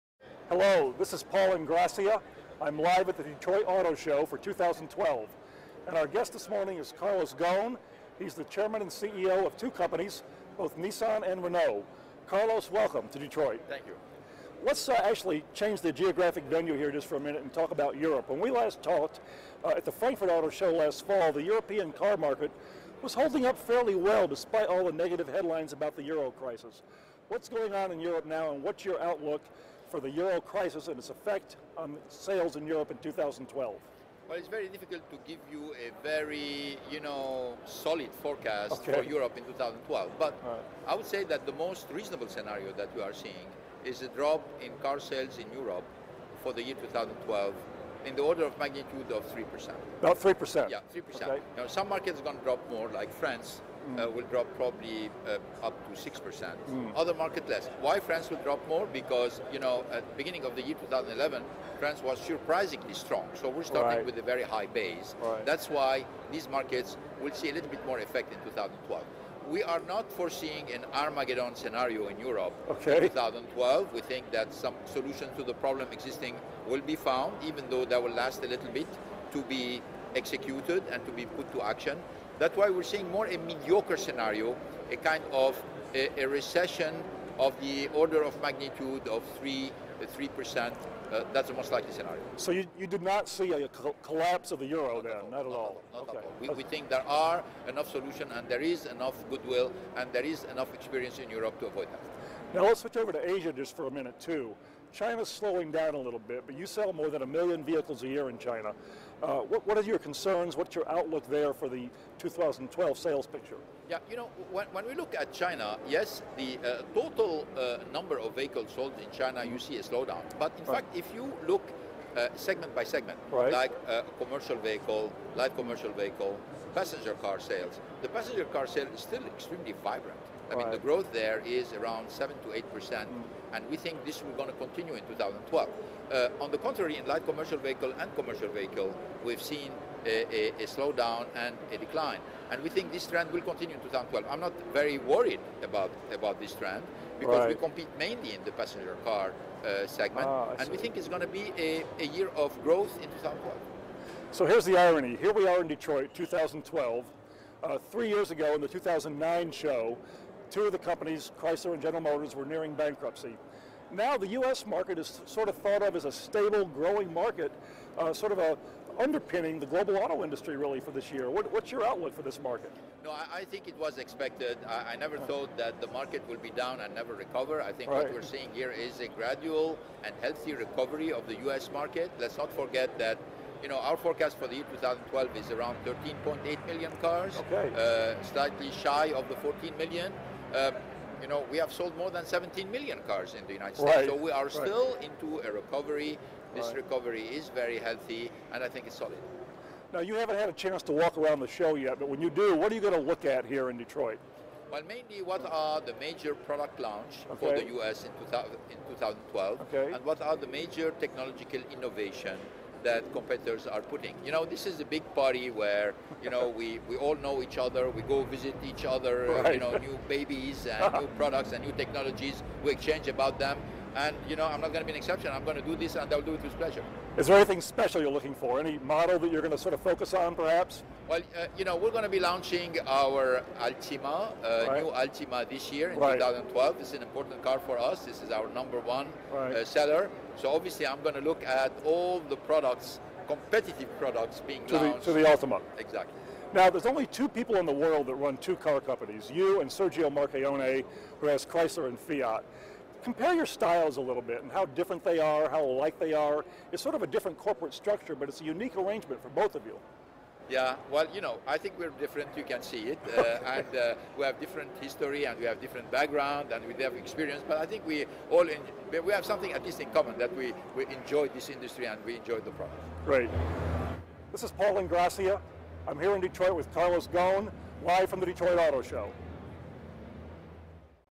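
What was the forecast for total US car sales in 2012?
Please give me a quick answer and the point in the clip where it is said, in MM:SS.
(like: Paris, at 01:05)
13.8 million, at 03:05.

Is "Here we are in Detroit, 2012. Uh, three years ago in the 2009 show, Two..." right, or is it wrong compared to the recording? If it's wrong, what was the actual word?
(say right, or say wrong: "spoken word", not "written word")
right.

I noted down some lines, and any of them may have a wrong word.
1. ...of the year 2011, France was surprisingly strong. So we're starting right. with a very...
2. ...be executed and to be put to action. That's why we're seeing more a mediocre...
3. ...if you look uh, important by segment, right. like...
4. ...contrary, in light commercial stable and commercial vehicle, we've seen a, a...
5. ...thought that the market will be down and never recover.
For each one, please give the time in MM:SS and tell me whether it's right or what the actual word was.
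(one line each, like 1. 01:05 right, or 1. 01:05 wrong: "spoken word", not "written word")
1. 01:00 right
2. 01:19 right
3. 02:00 wrong: "segment", not "important"
4. 02:16 wrong: "vehicle", not "stable"
5. 02:55 right.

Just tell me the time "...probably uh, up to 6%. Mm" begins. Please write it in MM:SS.
00:54.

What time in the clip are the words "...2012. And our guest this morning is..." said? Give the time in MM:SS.
00:04.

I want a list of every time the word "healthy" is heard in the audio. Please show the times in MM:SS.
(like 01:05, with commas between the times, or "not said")
03:00, 03:17.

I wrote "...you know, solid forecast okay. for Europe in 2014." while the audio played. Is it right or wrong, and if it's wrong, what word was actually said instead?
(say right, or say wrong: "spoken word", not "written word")
wrong: "2012", not "2014".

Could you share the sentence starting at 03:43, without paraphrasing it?
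And you know, I'm not going to be an exception.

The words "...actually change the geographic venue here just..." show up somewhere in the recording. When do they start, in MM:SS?
00:15.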